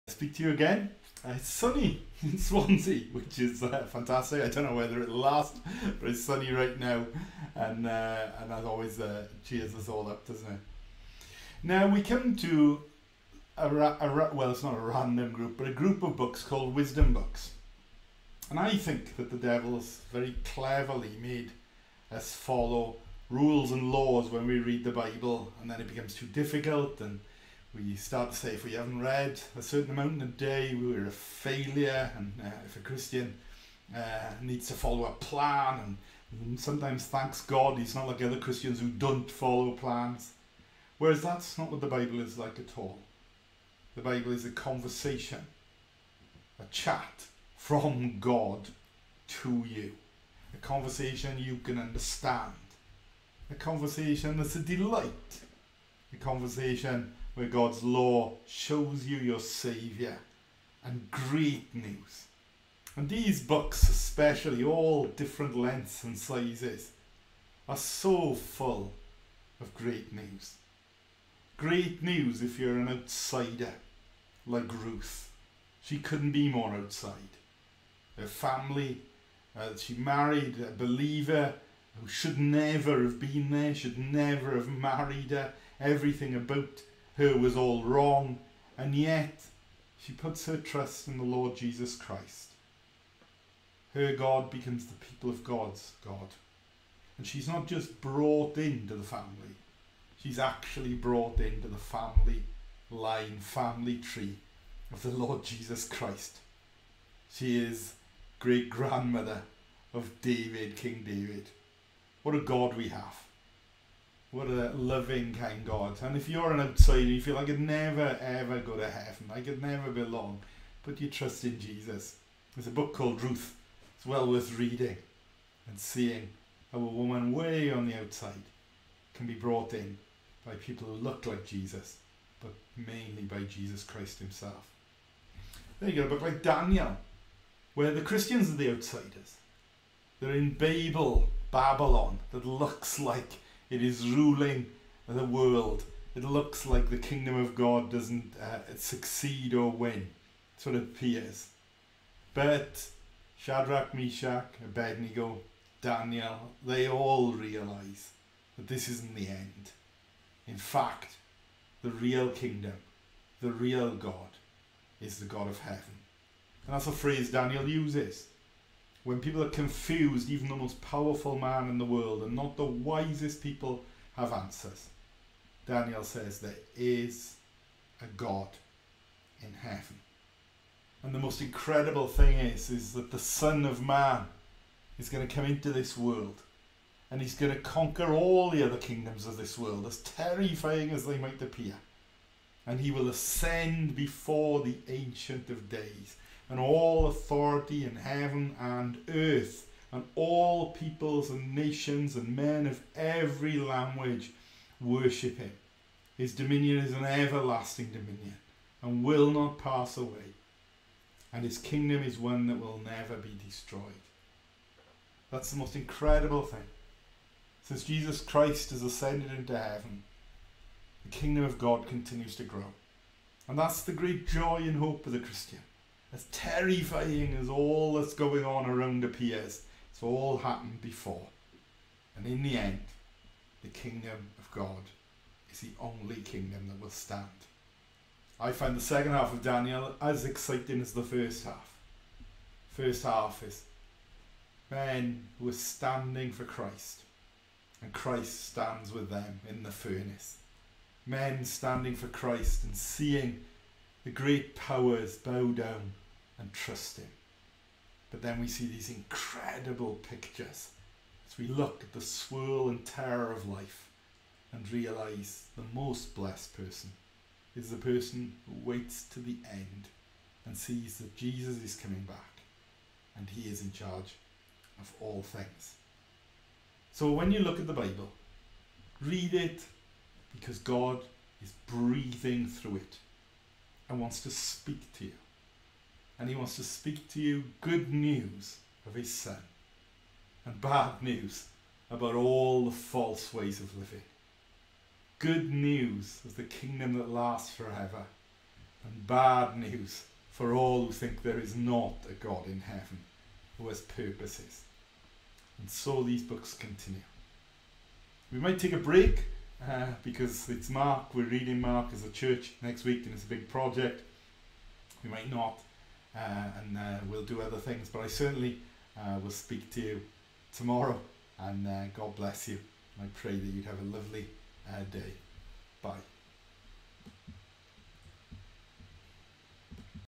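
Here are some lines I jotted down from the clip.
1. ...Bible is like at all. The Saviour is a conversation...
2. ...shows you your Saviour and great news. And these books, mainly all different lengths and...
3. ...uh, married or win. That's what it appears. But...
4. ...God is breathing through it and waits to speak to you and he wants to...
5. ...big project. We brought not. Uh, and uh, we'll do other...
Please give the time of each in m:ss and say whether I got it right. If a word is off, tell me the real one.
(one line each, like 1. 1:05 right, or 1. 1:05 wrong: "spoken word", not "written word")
1. 0:41 wrong: "Bible", not "Saviour"
2. 0:58 wrong: "especially", not "mainly"
3. 2:28 wrong: "succeed", not "married"
4. 4:40 wrong: "wants", not "waits"
5. 5:13 wrong: "might", not "brought".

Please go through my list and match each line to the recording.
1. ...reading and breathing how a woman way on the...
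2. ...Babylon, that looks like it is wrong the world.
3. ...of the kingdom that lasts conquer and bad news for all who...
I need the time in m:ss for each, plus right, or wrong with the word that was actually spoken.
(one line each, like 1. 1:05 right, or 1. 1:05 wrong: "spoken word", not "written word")
1. 2:04 wrong: "seeing", not "breathing"
2. 2:21 wrong: "ruling", not "wrong"
3. 4:56 wrong: "forever", not "conquer".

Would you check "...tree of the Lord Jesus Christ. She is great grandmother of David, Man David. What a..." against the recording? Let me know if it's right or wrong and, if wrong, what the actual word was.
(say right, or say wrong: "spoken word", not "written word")
wrong: "King", not "Man".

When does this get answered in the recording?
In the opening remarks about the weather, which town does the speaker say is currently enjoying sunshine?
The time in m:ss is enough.
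0:02.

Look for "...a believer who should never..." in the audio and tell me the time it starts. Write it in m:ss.
1:20.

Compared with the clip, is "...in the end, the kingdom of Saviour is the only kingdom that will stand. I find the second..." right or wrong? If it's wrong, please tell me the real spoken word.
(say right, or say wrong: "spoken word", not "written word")
wrong: "God", not "Saviour".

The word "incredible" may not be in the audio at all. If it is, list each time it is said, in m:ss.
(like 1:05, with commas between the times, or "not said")
3:01, 3:35, 4:18.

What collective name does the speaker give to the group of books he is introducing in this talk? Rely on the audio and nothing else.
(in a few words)
wisdom books.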